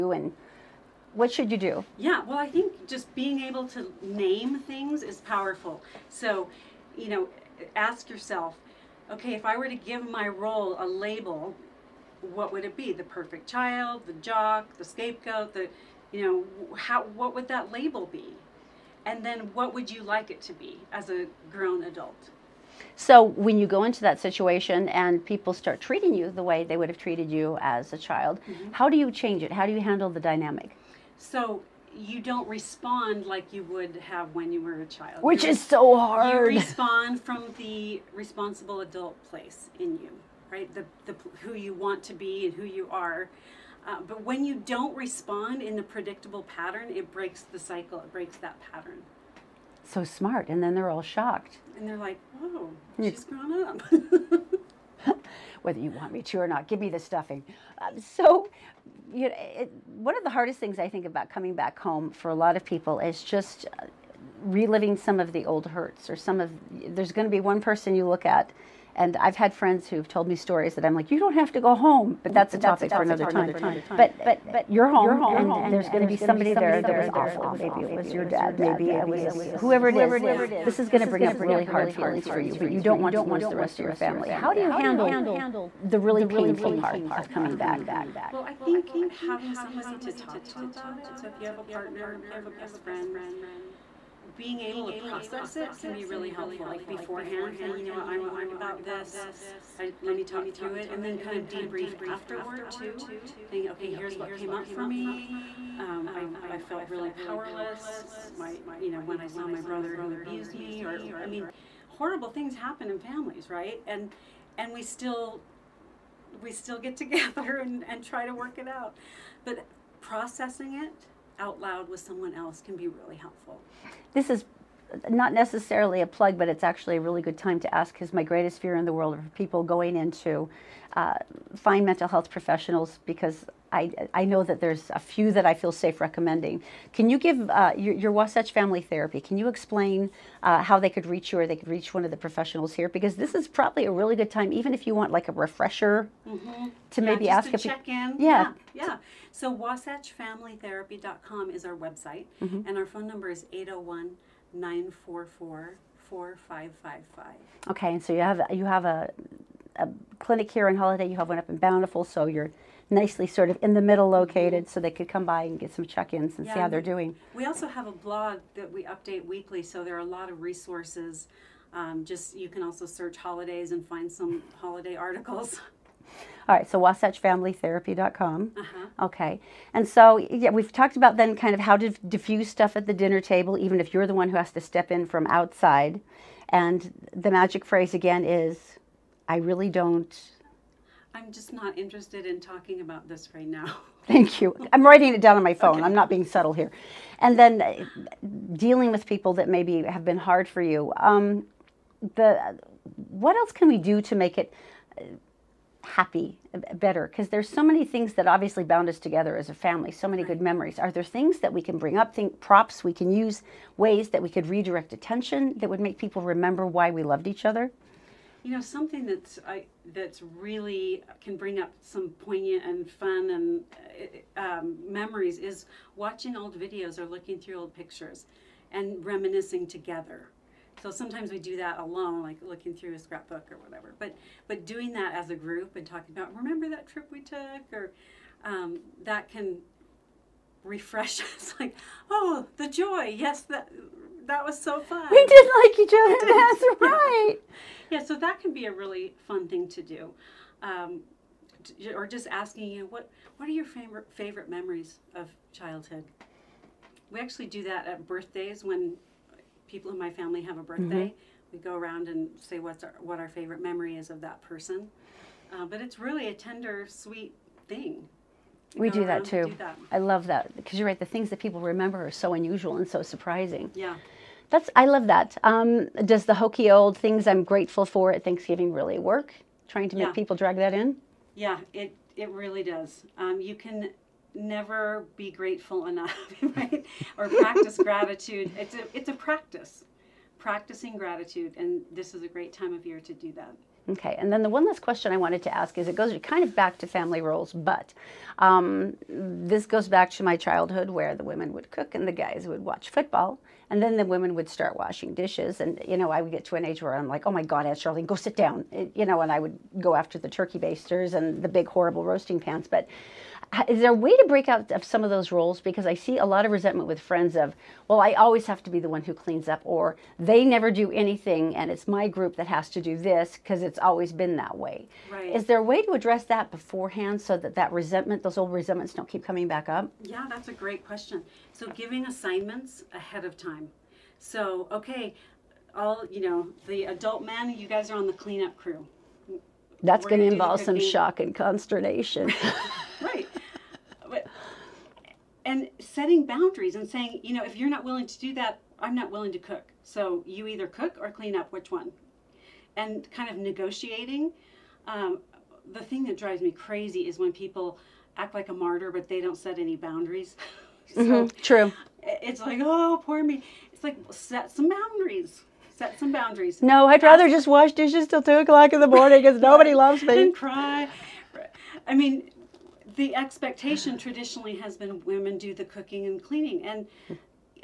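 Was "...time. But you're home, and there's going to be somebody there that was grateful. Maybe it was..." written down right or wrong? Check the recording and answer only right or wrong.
wrong.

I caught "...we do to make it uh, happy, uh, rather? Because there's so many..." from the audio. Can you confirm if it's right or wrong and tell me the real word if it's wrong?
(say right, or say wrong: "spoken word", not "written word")
wrong: "better", not "rather".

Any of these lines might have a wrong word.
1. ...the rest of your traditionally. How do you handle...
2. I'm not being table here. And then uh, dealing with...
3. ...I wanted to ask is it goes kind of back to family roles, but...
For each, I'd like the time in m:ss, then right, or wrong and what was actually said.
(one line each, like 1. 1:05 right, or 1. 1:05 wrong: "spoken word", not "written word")
1. 1:23 wrong: "family", not "traditionally"
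2. 3:15 wrong: "subtle", not "table"
3. 4:55 right.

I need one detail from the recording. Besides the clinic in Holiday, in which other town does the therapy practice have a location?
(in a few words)
Bountiful.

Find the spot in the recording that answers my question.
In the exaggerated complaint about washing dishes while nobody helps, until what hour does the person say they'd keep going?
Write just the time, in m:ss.
6:08.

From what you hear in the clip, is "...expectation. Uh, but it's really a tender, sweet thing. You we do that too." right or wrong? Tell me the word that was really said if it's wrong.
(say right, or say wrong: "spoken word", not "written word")
wrong: "person", not "expectation".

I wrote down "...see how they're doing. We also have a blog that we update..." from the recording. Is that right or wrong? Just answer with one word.
right.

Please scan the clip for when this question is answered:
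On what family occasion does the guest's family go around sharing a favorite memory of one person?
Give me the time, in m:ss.
4:18.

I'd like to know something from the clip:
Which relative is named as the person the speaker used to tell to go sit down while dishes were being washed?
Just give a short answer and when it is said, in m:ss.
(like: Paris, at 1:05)
Aunt Charlene, at 5:07.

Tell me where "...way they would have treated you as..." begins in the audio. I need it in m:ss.
0:26.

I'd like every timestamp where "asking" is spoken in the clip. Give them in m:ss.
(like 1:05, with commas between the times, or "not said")
4:12.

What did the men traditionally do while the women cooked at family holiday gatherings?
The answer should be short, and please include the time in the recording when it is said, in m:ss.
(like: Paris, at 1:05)
watch football, at 5:02.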